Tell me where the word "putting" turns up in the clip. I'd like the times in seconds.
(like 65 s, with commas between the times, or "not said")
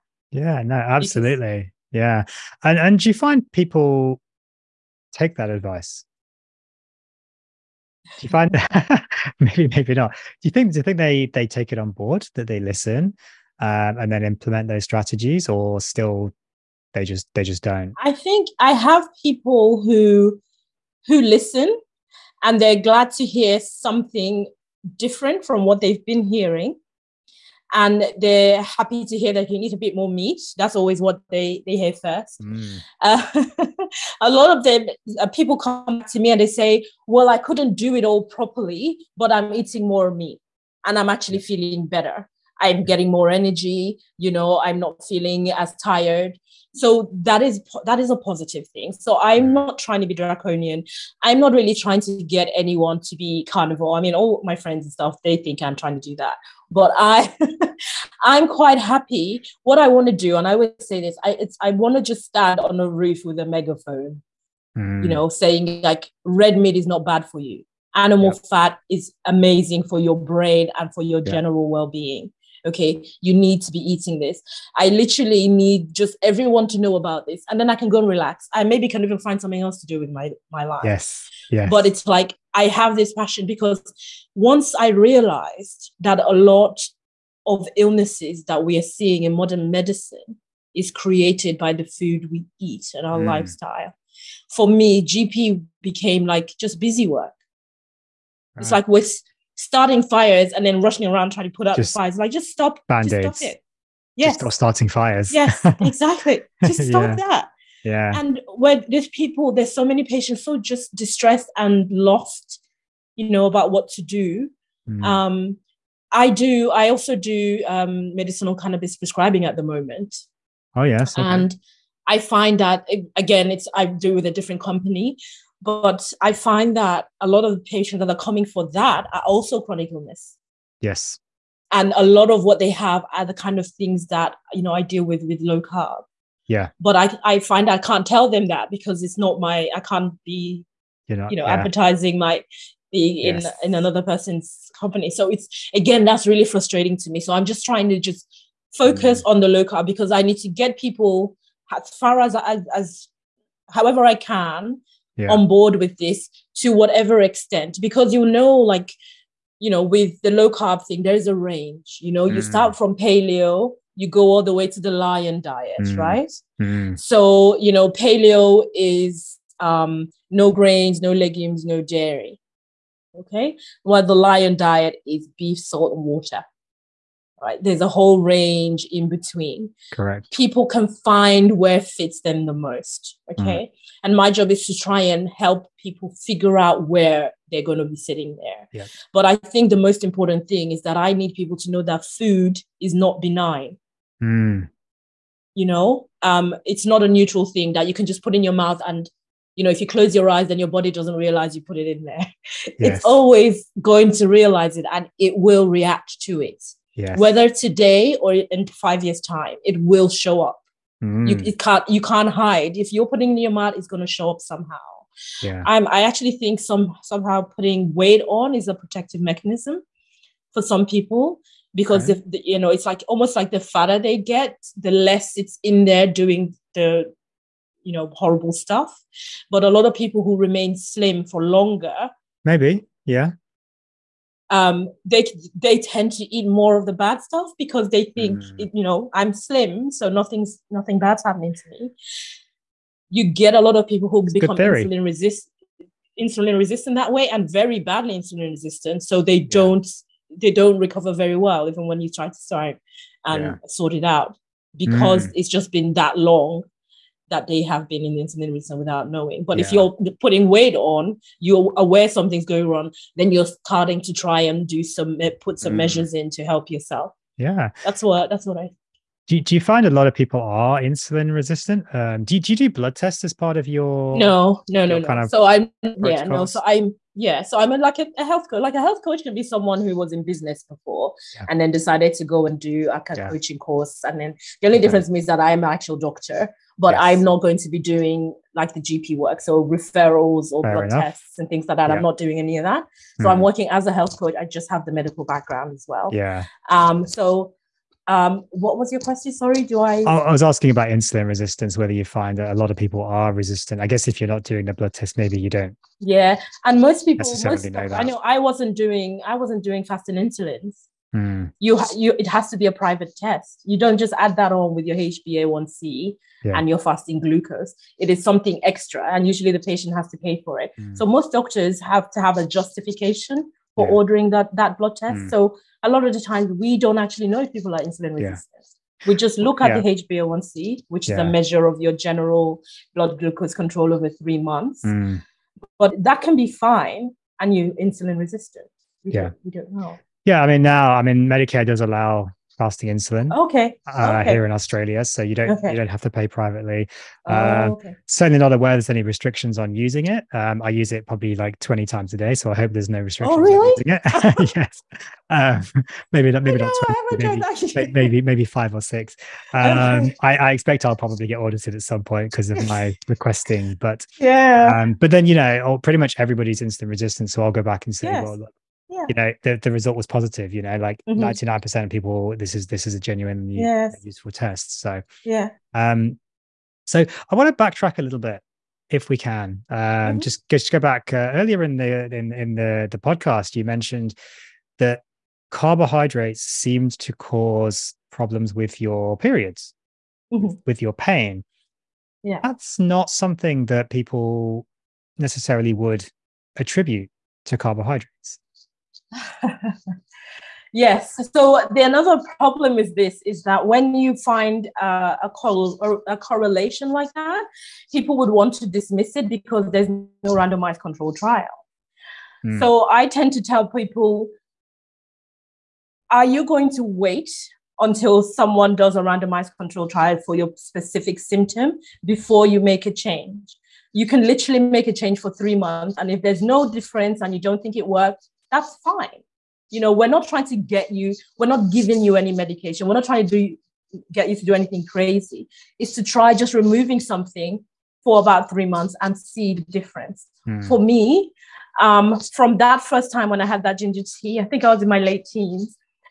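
213 s, 217 s, 260 s.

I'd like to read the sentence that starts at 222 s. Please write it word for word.
if you know it's like almost like the fatter they get, the less it's in there doing the you know horrible stuff.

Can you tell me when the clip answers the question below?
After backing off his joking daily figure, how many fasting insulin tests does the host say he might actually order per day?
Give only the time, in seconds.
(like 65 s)
358 s.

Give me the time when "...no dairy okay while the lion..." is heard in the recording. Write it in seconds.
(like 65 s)
171 s.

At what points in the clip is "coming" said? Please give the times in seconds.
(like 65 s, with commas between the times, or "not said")
128 s.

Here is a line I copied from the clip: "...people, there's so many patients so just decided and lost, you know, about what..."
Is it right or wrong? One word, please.
wrong.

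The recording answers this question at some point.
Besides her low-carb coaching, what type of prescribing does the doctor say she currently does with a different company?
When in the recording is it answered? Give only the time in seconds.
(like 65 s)
118 s.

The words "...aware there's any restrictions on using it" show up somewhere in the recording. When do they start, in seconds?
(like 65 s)
348 s.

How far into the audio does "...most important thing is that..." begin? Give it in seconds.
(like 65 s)
189 s.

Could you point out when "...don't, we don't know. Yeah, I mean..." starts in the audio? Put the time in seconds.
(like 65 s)
339 s.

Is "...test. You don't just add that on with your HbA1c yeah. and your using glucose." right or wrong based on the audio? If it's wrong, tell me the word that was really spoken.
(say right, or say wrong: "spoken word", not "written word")
wrong: "fasting", not "using".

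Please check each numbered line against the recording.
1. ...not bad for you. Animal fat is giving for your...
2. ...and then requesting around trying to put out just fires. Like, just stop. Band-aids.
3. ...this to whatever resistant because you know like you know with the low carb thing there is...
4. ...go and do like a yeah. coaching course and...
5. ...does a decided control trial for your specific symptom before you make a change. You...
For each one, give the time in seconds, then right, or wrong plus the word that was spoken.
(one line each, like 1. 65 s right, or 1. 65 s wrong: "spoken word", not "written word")
1. 66 s wrong: "amazing", not "giving"
2. 100 s wrong: "rushing", not "requesting"
3. 155 s wrong: "extent", not "resistant"
4. 282 s right
5. 418 s wrong: "randomized", not "decided".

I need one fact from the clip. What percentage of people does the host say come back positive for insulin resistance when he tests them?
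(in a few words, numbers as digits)
99%.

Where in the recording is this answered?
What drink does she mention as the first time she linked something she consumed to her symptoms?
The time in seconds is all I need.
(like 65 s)
443 s.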